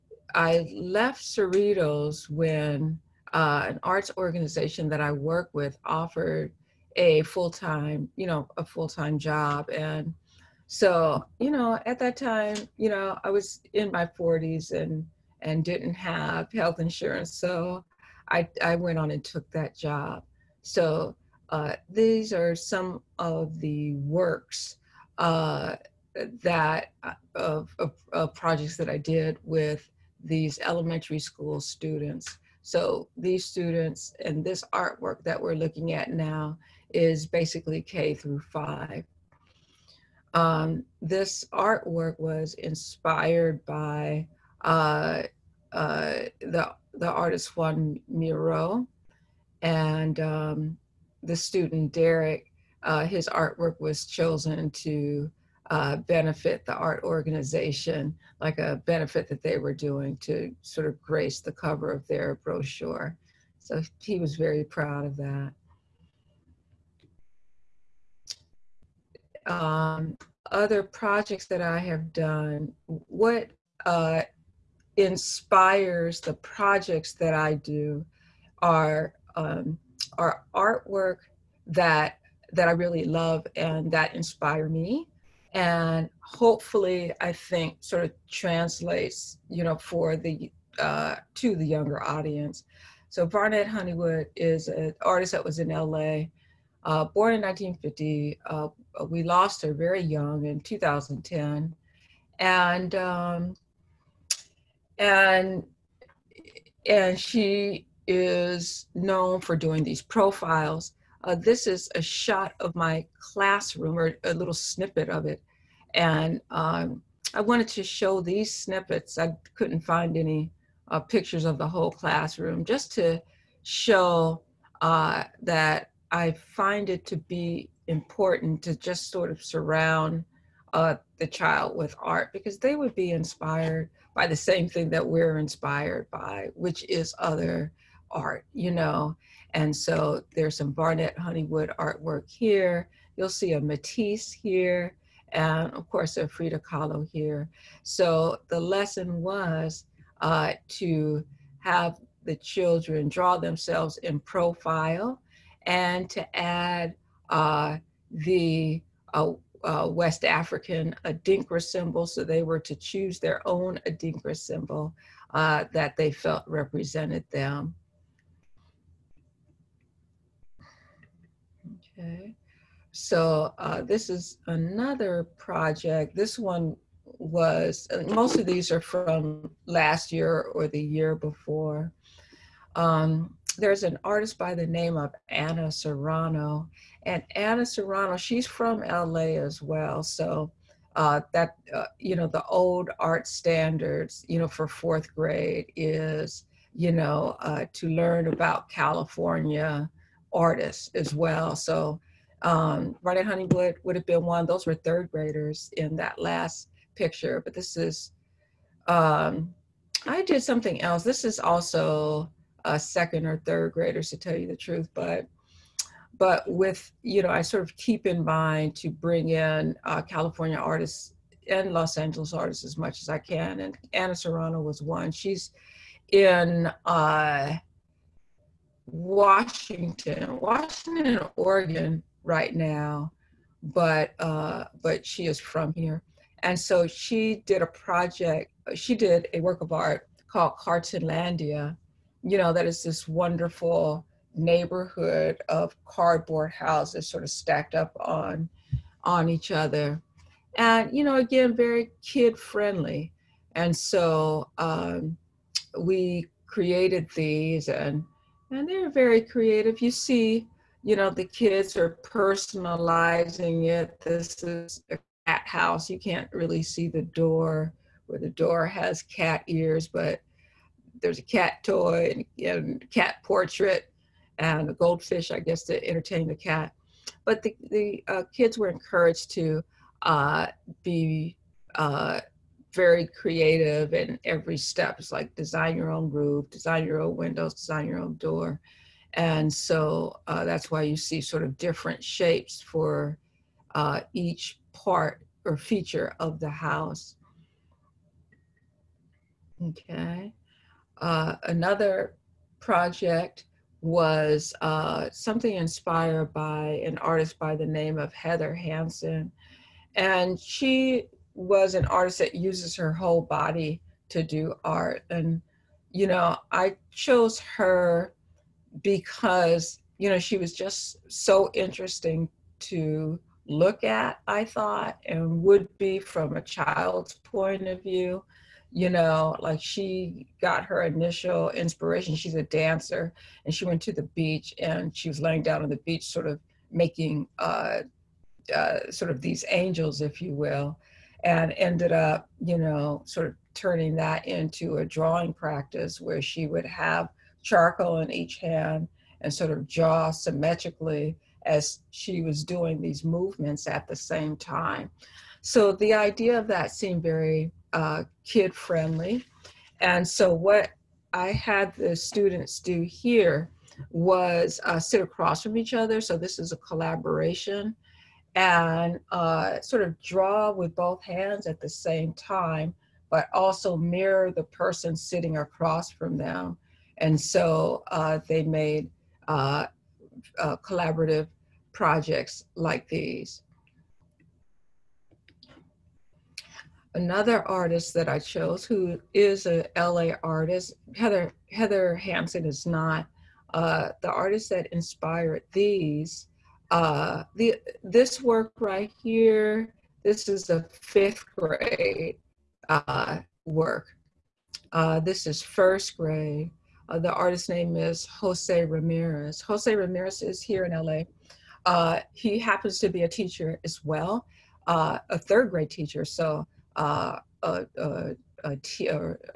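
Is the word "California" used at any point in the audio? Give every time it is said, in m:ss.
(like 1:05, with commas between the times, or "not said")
3:18, 3:40.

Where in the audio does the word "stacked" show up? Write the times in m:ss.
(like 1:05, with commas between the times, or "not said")
4:07.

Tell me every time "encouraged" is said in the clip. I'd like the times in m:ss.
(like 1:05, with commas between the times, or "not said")
4:38.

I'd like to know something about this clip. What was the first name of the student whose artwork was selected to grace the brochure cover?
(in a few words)
Derek.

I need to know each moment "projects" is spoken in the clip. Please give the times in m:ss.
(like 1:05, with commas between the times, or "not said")
0:28, 1:10, 1:16, 2:55, 3:57, 5:02, 6:21.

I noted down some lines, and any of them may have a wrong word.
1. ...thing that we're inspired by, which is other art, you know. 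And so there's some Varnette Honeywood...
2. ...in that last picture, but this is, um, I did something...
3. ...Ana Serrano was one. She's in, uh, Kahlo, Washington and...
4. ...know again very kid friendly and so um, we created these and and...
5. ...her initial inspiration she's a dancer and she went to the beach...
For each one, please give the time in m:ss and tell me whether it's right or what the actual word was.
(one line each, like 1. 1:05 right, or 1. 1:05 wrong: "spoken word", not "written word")
1. 2:14 right
2. 3:25 right
3. 3:43 wrong: "Washington", not "Kahlo"
4. 4:11 right
5. 5:30 right.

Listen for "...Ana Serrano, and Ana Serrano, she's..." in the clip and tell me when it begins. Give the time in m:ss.
3:05.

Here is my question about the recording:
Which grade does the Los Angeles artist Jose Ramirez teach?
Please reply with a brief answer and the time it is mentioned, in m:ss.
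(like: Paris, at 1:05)
Third grade, at 6:55.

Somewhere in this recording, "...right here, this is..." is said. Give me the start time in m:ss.
6:38.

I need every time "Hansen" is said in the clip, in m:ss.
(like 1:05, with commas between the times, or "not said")
5:08, 6:31.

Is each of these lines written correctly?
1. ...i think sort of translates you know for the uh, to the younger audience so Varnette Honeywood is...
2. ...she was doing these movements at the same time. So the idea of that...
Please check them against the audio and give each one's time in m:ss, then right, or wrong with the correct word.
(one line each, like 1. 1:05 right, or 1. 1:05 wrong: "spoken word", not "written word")
1. 1:27 right
2. 5:51 right.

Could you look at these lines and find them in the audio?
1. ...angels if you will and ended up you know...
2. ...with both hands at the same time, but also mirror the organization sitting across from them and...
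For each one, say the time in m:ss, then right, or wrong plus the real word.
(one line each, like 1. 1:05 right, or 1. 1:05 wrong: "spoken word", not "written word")
1. 5:39 right
2. 6:10 wrong: "person", not "organization".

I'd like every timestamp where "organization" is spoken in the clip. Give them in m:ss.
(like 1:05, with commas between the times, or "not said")
0:04, 0:57.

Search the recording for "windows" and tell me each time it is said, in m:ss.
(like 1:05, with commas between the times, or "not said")
4:47.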